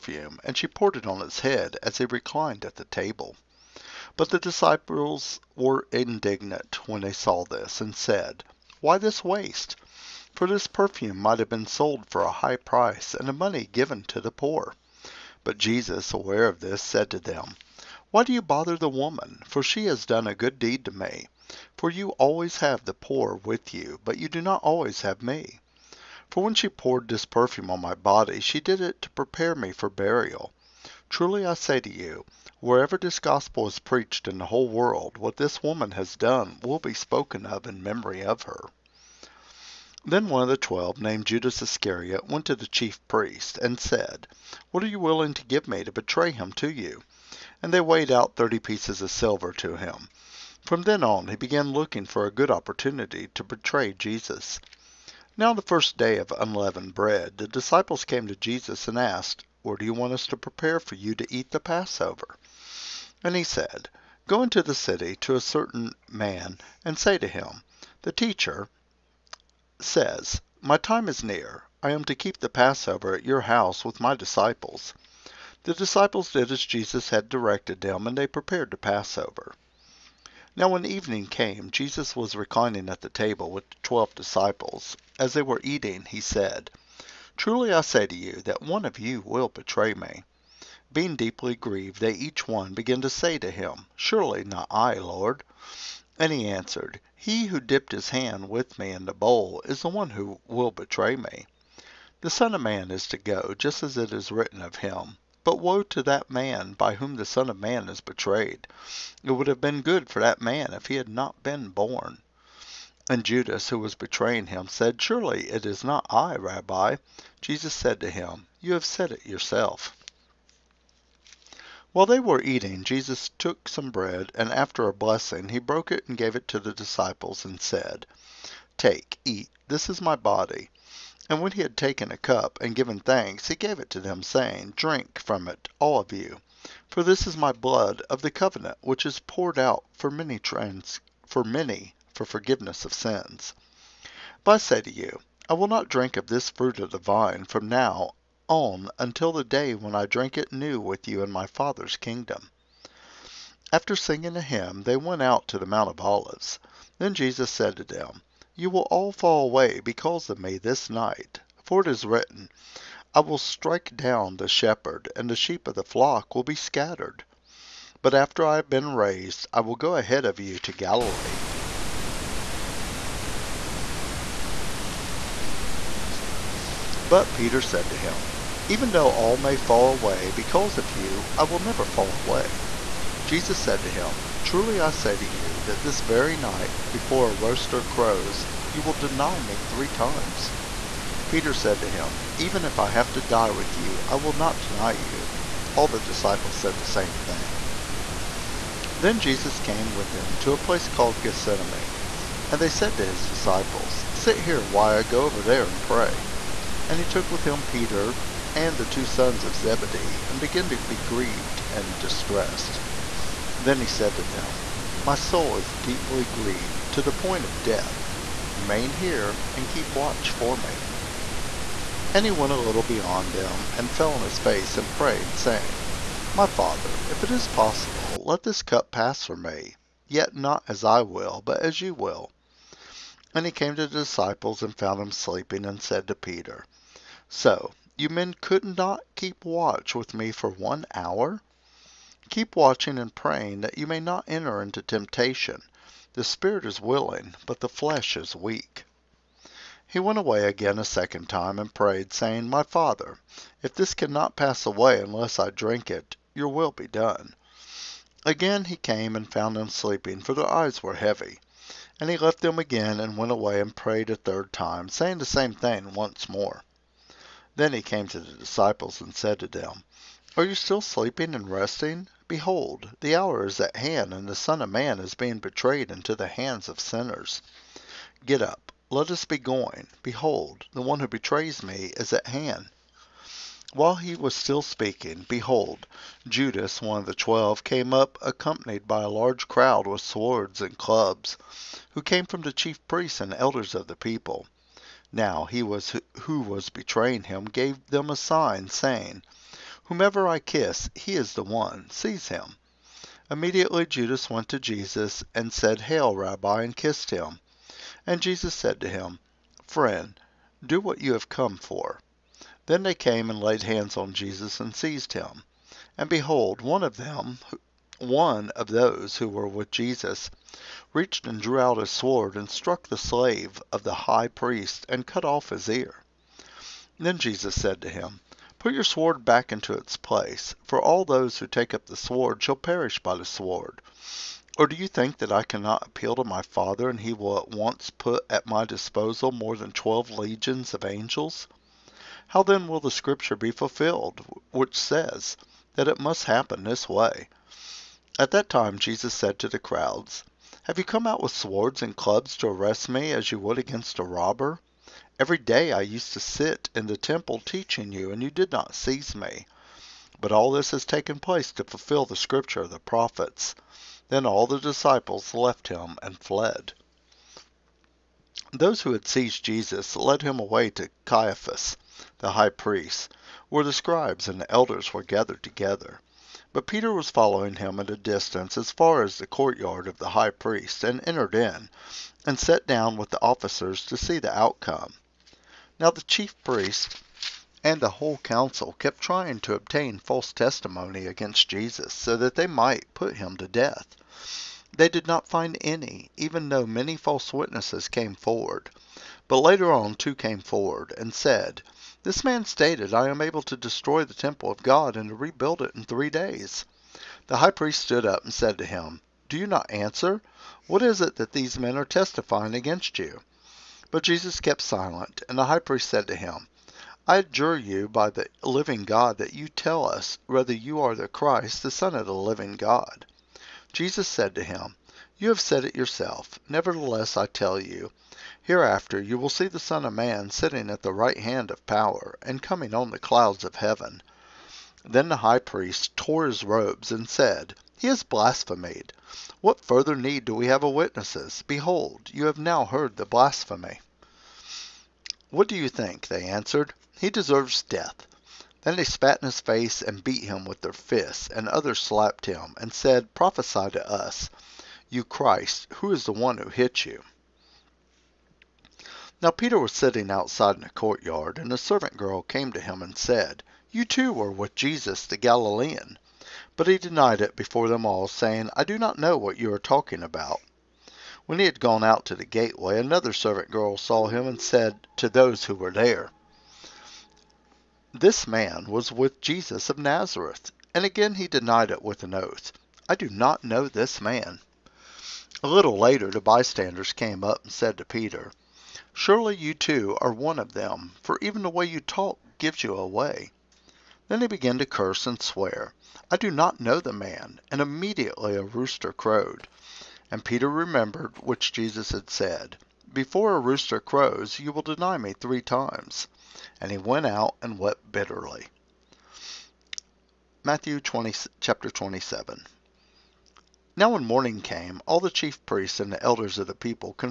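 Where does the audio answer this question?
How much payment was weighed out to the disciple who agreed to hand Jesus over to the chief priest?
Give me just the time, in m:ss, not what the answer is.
0:48.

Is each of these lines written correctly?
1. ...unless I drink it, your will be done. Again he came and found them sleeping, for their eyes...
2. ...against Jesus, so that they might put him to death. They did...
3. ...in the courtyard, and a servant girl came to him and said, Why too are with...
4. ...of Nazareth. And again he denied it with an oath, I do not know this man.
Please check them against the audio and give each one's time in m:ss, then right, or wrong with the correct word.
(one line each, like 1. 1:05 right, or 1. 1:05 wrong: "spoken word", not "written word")
1. 4:14 right
2. 6:31 right
3. 7:40 wrong: "You", not "Why"
4. 7:59 right.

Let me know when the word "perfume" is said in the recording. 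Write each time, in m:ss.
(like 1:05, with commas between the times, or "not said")
0:10, 0:27.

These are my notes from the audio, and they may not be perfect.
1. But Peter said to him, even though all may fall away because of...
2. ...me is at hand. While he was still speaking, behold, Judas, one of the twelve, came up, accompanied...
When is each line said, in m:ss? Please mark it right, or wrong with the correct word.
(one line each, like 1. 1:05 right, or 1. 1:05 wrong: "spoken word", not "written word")
1. 2:57 right
2. 4:41 right.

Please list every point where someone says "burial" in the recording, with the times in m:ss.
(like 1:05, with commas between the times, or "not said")
0:29.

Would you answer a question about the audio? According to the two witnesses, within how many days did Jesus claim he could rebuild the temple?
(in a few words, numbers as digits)
3.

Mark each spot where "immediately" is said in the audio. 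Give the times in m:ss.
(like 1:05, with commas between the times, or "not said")
5:03, 8:17.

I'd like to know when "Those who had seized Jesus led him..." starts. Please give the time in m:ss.
6:08.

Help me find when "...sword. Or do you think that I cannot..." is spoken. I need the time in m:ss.
5:33.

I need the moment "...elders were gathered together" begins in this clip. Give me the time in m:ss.
6:14.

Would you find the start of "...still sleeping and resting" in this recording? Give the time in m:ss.
4:30.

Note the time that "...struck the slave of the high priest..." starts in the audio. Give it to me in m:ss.
5:22.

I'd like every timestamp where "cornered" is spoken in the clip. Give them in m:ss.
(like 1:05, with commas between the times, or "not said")
not said.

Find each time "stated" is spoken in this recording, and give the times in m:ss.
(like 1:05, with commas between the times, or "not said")
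6:42.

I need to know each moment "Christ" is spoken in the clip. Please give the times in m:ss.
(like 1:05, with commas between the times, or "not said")
7:01, 7:35.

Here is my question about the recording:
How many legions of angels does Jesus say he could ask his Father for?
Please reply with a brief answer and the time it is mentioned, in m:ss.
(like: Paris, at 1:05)
12, at 5:39.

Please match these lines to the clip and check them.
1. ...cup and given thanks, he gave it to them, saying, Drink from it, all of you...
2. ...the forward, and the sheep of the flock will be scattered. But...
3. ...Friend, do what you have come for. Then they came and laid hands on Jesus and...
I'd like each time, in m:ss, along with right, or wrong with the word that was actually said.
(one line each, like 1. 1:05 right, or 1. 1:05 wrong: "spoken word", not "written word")
1. 2:12 right
2. 2:44 wrong: "shepherd", not "forward"
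3. 5:09 right.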